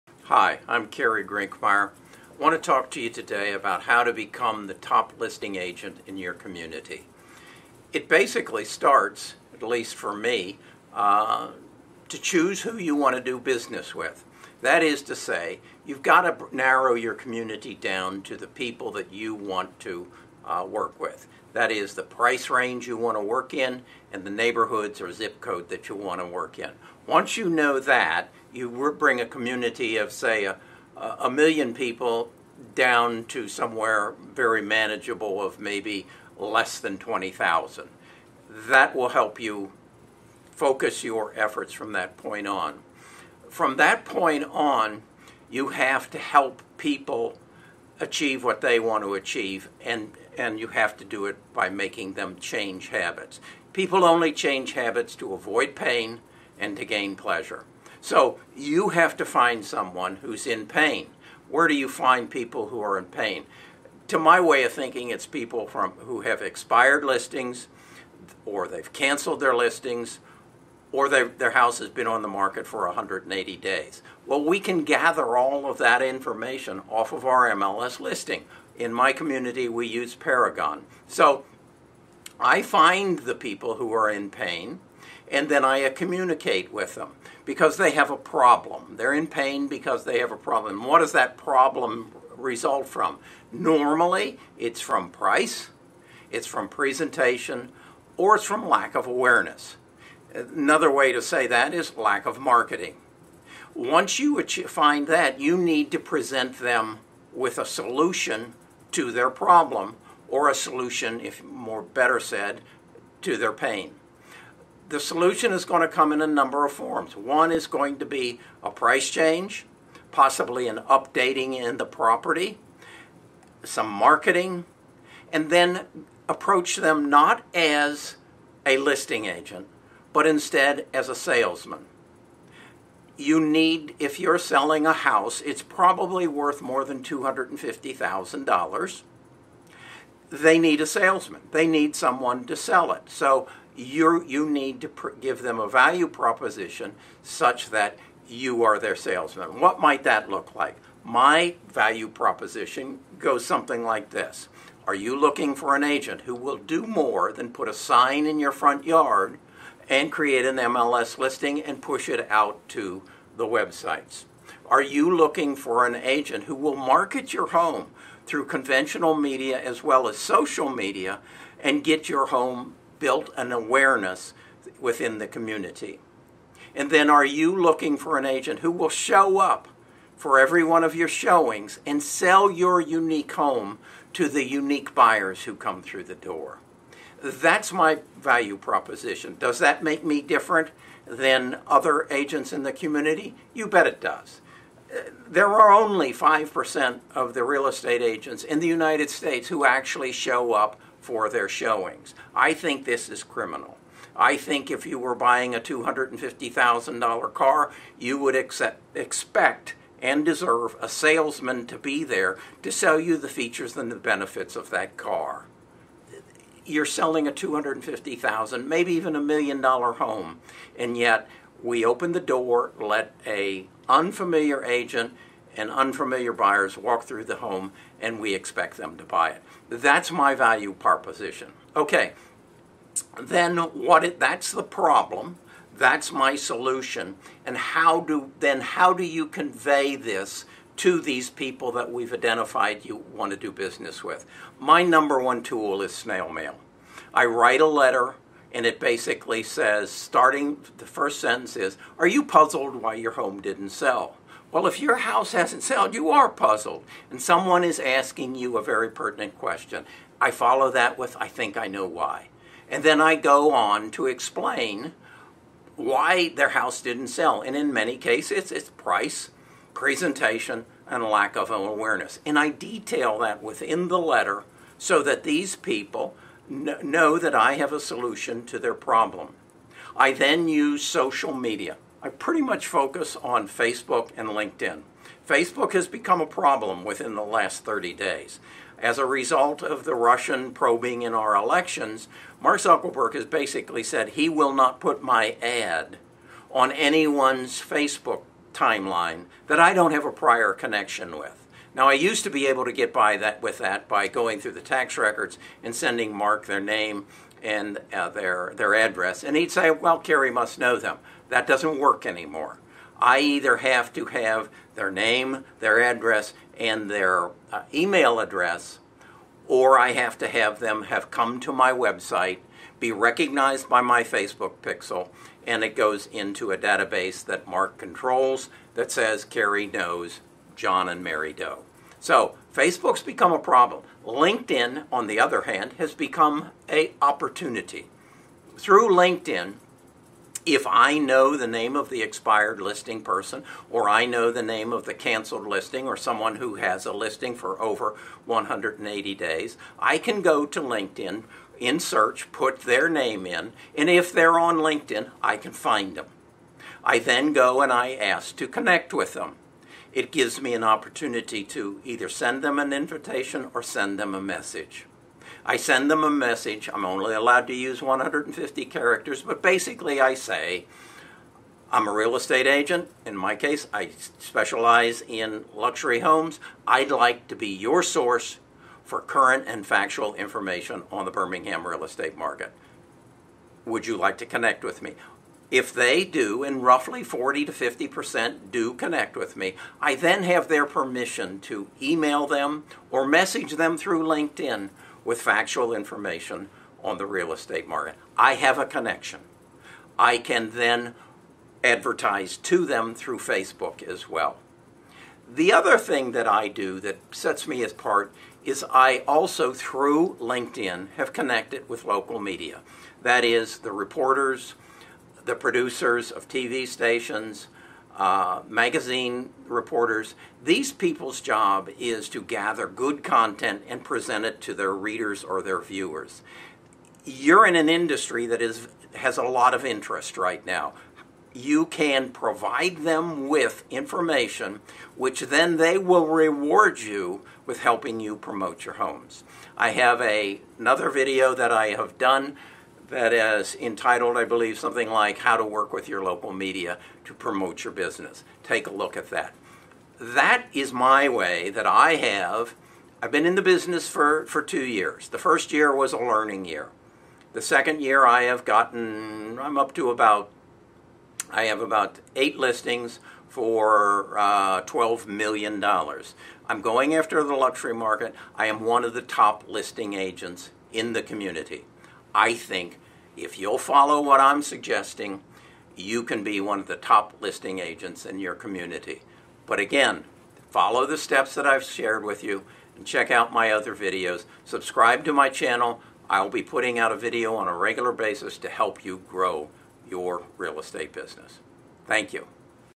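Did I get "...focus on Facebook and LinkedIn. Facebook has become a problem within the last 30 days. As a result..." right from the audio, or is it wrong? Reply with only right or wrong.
right.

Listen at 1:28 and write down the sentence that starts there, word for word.
They're in pain because they have a problem.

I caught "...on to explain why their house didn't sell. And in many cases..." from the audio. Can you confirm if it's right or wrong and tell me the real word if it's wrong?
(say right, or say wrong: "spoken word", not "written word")
right.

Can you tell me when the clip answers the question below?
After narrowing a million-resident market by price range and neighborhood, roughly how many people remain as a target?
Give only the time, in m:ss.
0:36.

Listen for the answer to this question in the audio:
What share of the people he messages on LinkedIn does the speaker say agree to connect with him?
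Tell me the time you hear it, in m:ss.
6:27.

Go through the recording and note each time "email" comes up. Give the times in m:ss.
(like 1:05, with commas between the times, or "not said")
5:17, 6:31.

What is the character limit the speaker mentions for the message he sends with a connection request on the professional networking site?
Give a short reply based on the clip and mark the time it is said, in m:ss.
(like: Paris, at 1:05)
150, at 6:07.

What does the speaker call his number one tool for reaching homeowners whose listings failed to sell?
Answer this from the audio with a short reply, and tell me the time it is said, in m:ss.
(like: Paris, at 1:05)
Snail mail, at 4:05.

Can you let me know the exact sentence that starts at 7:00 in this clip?
These people's job is to gather good content and present it to their readers or their viewers.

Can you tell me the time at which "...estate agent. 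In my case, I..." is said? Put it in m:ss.
6:12.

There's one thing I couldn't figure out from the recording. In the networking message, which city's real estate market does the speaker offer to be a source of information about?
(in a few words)
Birmingham.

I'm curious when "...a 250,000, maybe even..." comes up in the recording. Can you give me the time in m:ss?
3:37.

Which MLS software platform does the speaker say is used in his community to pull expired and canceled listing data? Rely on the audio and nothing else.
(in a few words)
Paragon.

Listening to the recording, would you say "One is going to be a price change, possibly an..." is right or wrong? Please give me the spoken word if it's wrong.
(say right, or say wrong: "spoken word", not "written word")
right.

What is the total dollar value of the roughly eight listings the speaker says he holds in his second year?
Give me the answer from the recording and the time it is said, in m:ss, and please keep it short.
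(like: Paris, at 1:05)
$12 million, at 7:44.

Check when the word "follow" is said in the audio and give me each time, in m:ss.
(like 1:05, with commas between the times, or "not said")
4:20, 7:53, 8:00.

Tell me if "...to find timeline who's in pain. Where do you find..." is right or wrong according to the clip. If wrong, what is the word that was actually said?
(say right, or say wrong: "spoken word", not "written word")
wrong: "someone", not "timeline".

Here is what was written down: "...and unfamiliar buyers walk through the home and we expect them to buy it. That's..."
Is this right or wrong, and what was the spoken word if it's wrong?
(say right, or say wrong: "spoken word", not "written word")
right.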